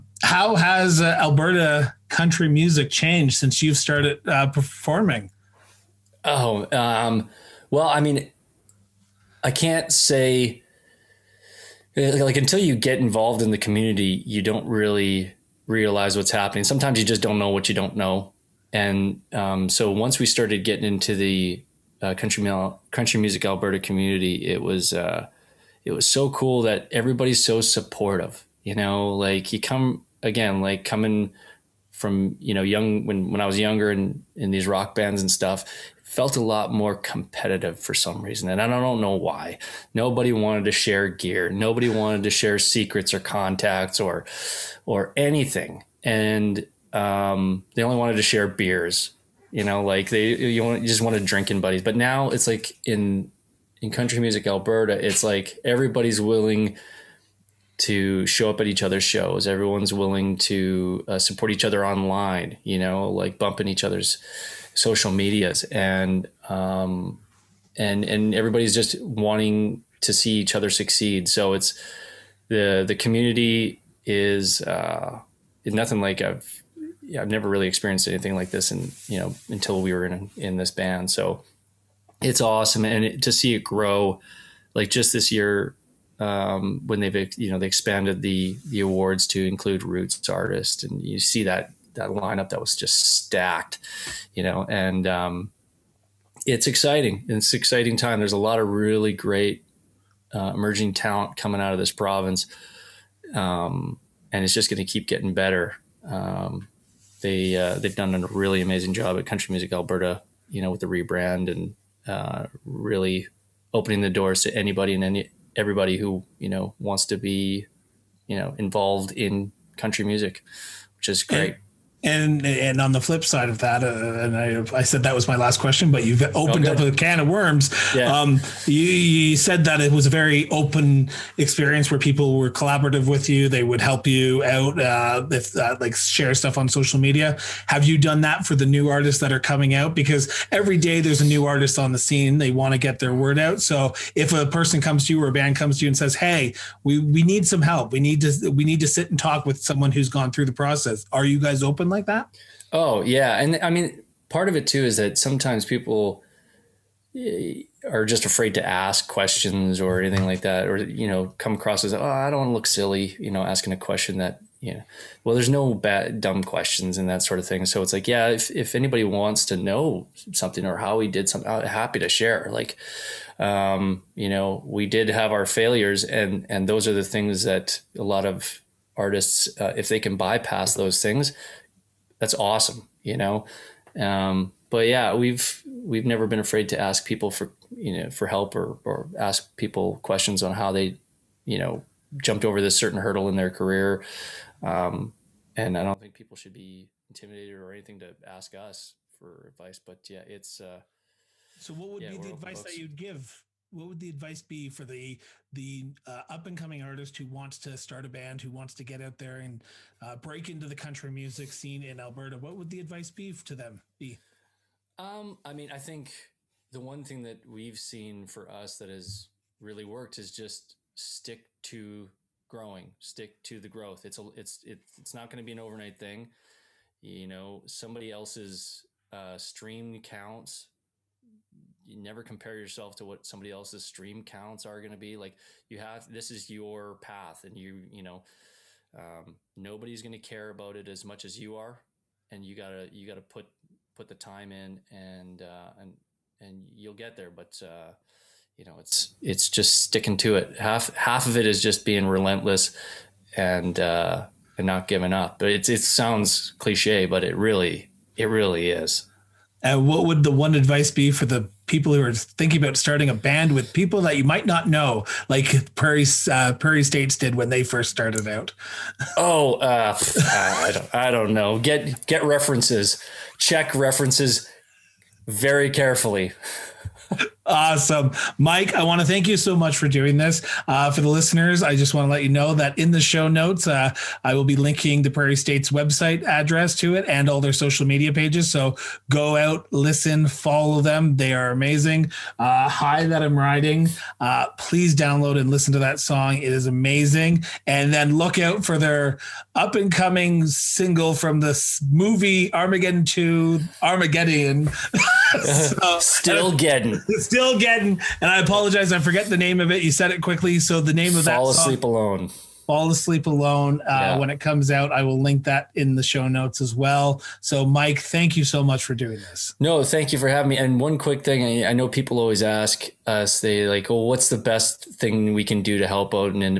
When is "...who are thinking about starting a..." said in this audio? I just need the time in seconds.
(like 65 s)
261 s.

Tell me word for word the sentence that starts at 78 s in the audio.
And, you know, until we were in, in this band.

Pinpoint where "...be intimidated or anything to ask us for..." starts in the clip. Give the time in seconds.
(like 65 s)
196 s.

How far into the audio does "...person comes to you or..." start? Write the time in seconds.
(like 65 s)
144 s.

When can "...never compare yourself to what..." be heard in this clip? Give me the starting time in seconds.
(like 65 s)
231 s.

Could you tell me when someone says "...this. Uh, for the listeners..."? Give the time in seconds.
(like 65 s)
280 s.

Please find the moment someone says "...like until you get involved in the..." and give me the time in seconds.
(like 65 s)
11 s.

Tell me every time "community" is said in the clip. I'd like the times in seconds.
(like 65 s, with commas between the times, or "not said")
13 s, 23 s, 72 s.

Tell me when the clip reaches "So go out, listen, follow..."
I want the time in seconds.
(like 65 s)
288 s.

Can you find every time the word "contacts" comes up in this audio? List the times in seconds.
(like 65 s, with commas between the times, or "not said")
43 s.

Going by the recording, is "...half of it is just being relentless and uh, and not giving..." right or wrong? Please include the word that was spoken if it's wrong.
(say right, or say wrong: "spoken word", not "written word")
right.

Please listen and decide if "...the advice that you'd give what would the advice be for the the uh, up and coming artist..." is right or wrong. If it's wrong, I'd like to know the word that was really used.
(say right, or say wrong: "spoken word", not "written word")
right.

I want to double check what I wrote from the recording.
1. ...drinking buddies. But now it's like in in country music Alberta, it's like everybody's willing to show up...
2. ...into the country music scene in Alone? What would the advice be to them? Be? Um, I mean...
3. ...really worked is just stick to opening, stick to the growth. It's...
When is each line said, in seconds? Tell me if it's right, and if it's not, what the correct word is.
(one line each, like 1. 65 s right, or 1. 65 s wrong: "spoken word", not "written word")
1. 51 s right
2. 210 s wrong: "Alberta", not "Alone"
3. 219 s wrong: "growing", not "opening".